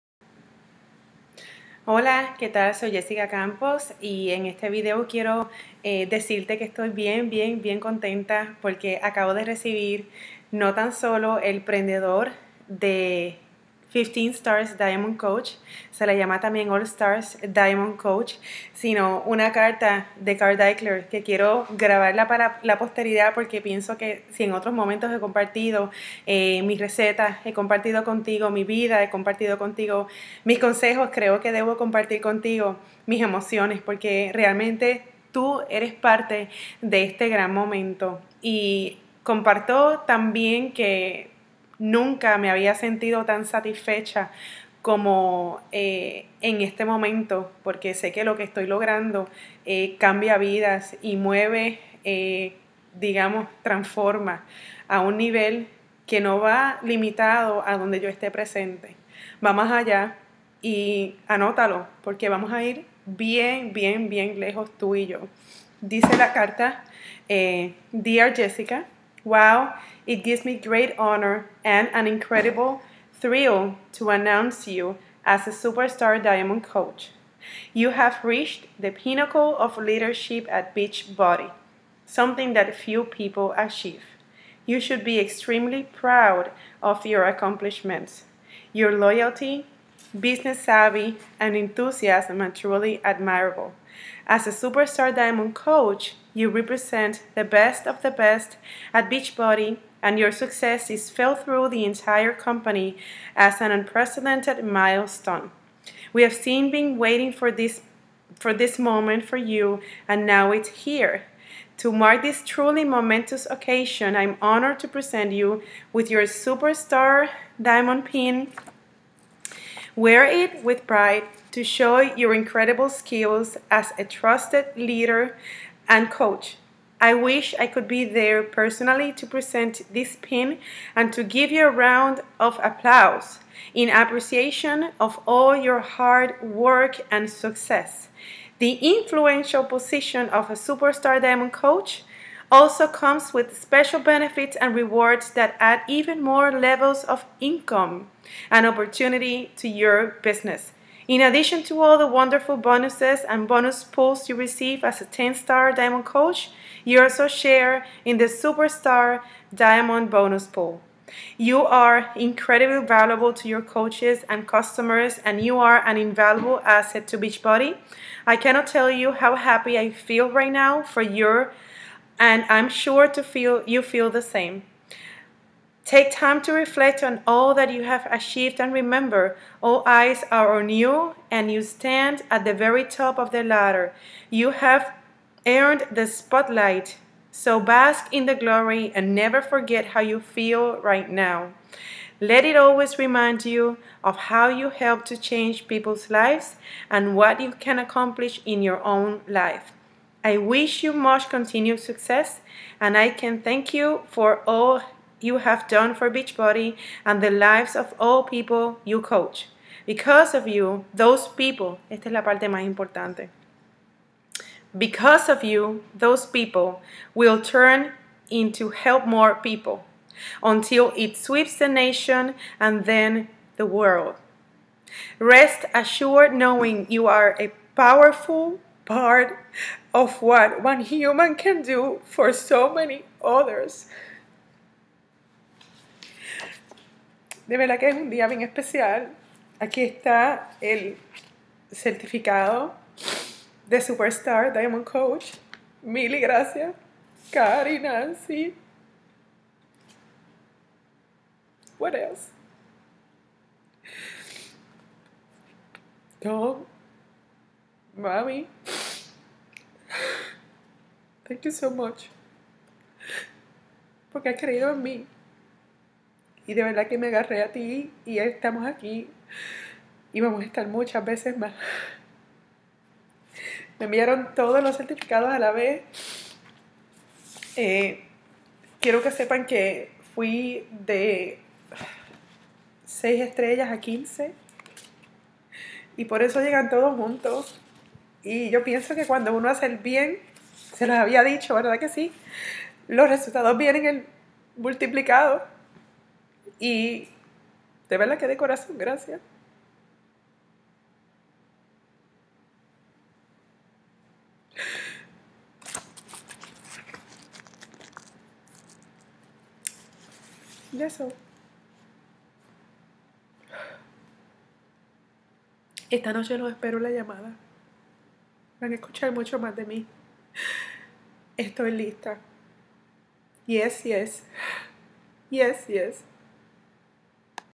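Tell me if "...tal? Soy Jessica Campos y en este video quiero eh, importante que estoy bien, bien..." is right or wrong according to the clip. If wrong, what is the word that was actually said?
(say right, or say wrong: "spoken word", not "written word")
wrong: "decirte", not "importante".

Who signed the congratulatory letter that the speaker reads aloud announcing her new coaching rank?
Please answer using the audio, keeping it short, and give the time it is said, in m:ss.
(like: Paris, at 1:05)
Carl Deichler, at 0:20.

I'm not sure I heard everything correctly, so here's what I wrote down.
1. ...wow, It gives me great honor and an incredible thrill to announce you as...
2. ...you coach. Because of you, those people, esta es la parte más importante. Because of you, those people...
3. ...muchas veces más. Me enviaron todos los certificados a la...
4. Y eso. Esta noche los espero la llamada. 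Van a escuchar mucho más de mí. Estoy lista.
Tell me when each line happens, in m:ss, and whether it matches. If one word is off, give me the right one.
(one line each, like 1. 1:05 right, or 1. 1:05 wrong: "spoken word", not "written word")
1. 1:09 right
2. 3:28 right
3. 4:30 right
4. 5:10 right.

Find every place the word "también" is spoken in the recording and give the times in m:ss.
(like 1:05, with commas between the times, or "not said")
0:16, 0:40.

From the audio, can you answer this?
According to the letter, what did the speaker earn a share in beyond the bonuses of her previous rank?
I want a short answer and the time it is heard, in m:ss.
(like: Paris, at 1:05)
Superstar Diamond Bonus Pool, at 2:38.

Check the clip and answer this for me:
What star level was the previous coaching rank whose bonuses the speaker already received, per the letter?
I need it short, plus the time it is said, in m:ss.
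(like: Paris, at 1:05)
10-star Diamond Coach, at 2:35.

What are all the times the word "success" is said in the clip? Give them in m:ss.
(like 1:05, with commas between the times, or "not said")
1:40, 2:17, 3:21.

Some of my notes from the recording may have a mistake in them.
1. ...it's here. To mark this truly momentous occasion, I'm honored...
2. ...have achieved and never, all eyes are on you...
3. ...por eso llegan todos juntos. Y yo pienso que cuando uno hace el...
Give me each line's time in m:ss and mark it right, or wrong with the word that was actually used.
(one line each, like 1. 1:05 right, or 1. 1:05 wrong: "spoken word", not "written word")
1. 1:50 right
2. 2:57 wrong: "remember", not "never"
3. 4:46 right.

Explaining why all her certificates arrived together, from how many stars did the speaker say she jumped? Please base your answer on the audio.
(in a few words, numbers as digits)
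6.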